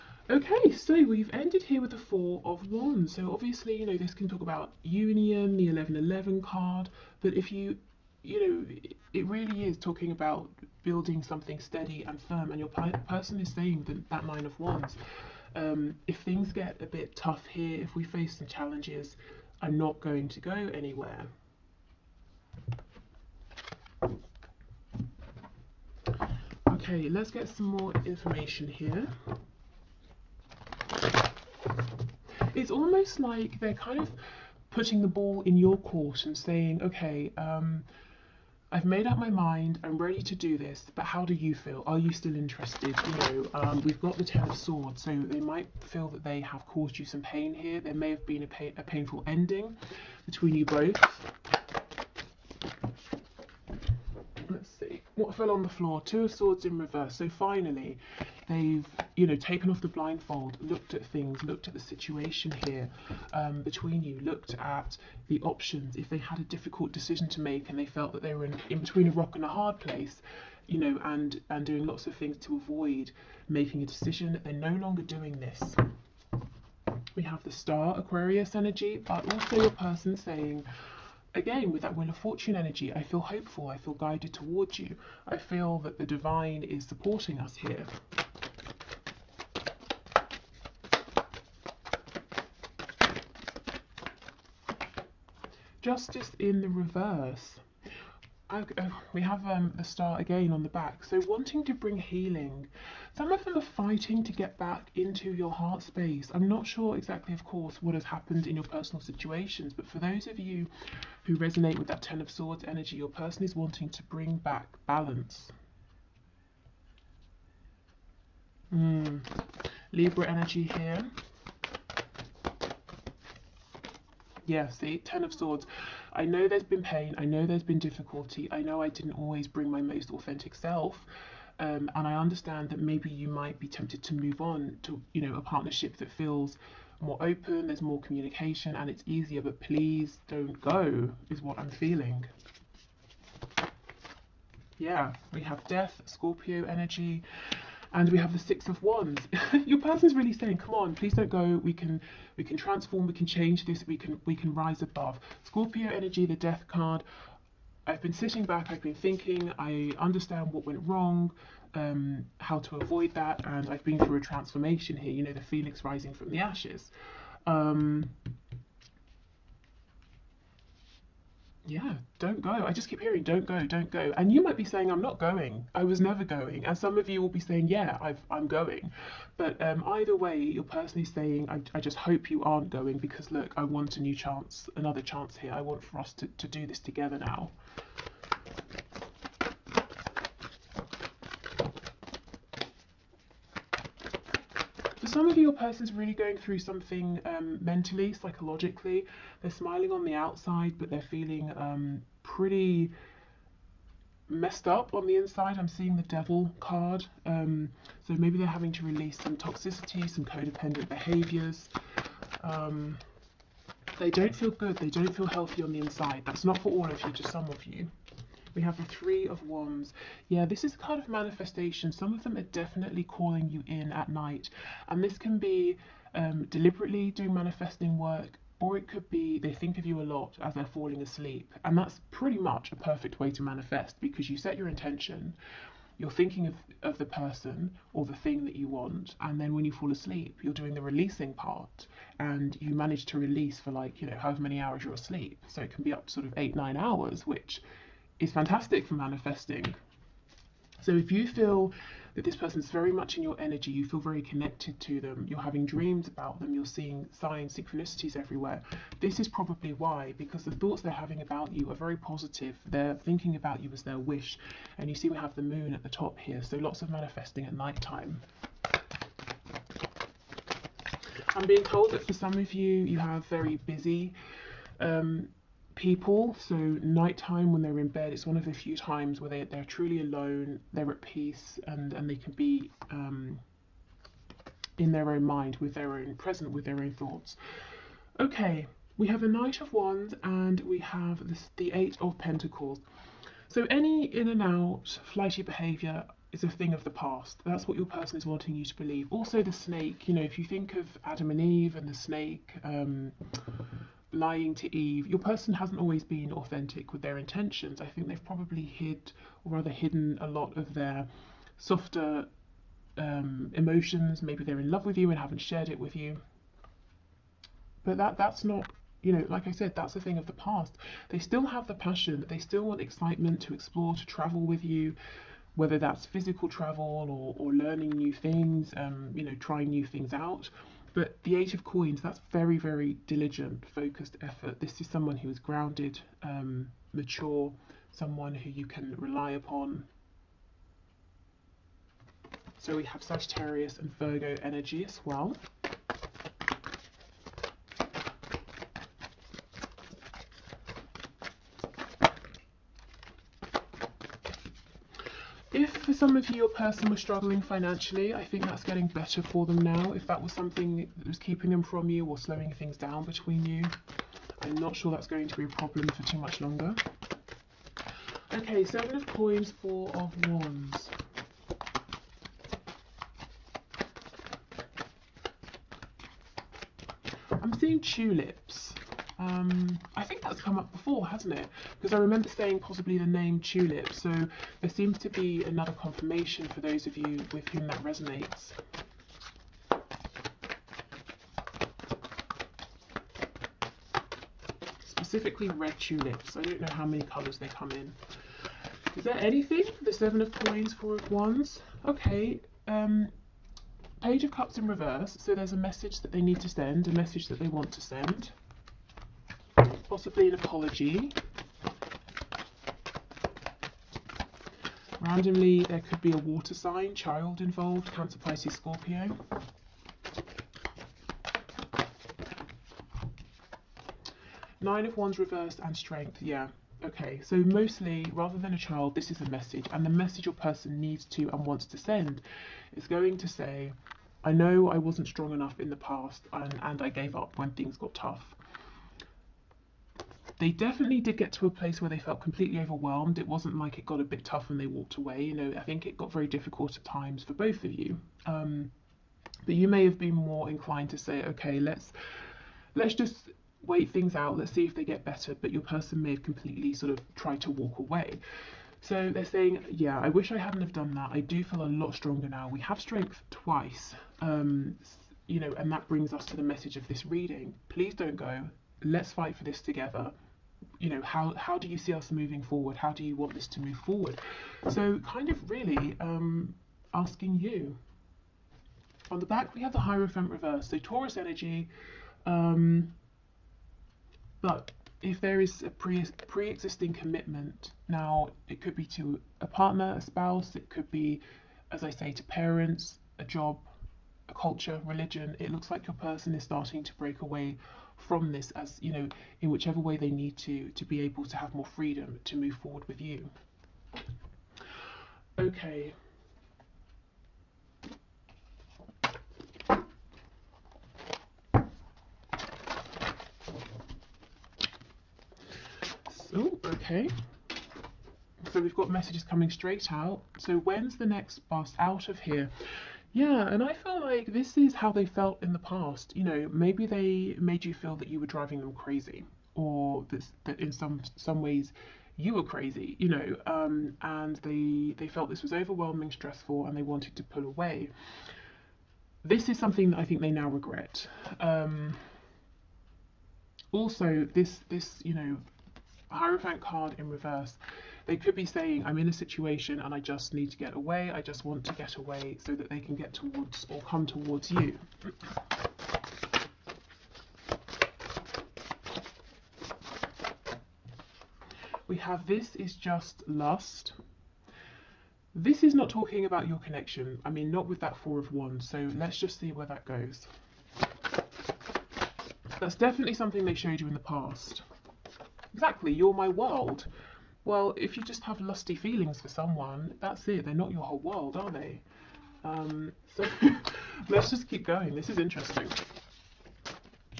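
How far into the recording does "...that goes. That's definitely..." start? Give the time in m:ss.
9:29.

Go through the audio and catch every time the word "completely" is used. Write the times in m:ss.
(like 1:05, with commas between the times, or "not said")
7:22, 7:36.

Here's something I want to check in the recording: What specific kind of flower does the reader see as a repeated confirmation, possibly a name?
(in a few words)
Red tulips.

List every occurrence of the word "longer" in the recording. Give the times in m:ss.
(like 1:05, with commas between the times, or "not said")
1:14, 6:06.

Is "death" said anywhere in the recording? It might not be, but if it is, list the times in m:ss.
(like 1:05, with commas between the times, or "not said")
2:25, 2:36.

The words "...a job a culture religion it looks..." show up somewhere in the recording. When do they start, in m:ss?
8:13.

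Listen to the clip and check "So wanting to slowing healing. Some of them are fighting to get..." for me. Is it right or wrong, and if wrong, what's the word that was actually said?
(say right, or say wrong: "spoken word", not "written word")
wrong: "bring", not "slowing".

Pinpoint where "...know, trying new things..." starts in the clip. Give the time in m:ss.
5:29.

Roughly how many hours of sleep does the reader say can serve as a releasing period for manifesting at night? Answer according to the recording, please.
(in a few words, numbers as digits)
8 or 9 hours.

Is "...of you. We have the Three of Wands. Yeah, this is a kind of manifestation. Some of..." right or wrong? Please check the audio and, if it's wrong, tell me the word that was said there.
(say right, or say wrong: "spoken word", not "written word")
right.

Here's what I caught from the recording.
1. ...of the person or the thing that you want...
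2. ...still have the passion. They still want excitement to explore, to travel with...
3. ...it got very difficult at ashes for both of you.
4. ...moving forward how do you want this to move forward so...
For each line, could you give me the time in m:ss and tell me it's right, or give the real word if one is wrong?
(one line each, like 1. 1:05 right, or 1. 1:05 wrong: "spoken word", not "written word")
1. 3:56 right
2. 5:21 right
3. 7:25 wrong: "times", not "ashes"
4. 7:52 right.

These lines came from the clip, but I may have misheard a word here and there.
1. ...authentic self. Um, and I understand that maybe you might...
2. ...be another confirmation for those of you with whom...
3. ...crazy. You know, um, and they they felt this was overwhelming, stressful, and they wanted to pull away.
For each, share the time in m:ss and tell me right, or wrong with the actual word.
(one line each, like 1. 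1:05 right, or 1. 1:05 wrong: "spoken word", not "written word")
1. 2:10 right
2. 6:25 right
3. 8:52 right.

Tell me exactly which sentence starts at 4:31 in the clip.
I'm being told that for some of you, you have very busy um, people.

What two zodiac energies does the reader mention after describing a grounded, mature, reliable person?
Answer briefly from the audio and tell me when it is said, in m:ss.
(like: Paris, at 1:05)
Sagittarius and Virgo, at 5:43.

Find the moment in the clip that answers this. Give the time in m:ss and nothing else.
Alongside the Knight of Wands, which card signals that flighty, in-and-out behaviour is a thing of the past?
4:51.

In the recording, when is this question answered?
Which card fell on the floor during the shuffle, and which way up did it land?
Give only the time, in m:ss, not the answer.
0:56.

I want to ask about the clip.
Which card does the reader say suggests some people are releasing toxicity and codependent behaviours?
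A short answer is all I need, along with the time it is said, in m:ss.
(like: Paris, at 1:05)
The Devil, at 3:25.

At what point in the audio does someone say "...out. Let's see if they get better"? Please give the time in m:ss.
7:34.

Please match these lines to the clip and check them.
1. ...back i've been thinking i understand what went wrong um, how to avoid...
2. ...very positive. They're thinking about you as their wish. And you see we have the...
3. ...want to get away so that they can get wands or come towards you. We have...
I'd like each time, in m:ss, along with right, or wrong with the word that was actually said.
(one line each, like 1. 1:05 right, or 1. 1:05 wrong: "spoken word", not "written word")
1. 2:38 right
2. 4:21 right
3. 9:11 wrong: "towards", not "wands".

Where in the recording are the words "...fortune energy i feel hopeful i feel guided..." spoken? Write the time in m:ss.
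1:22.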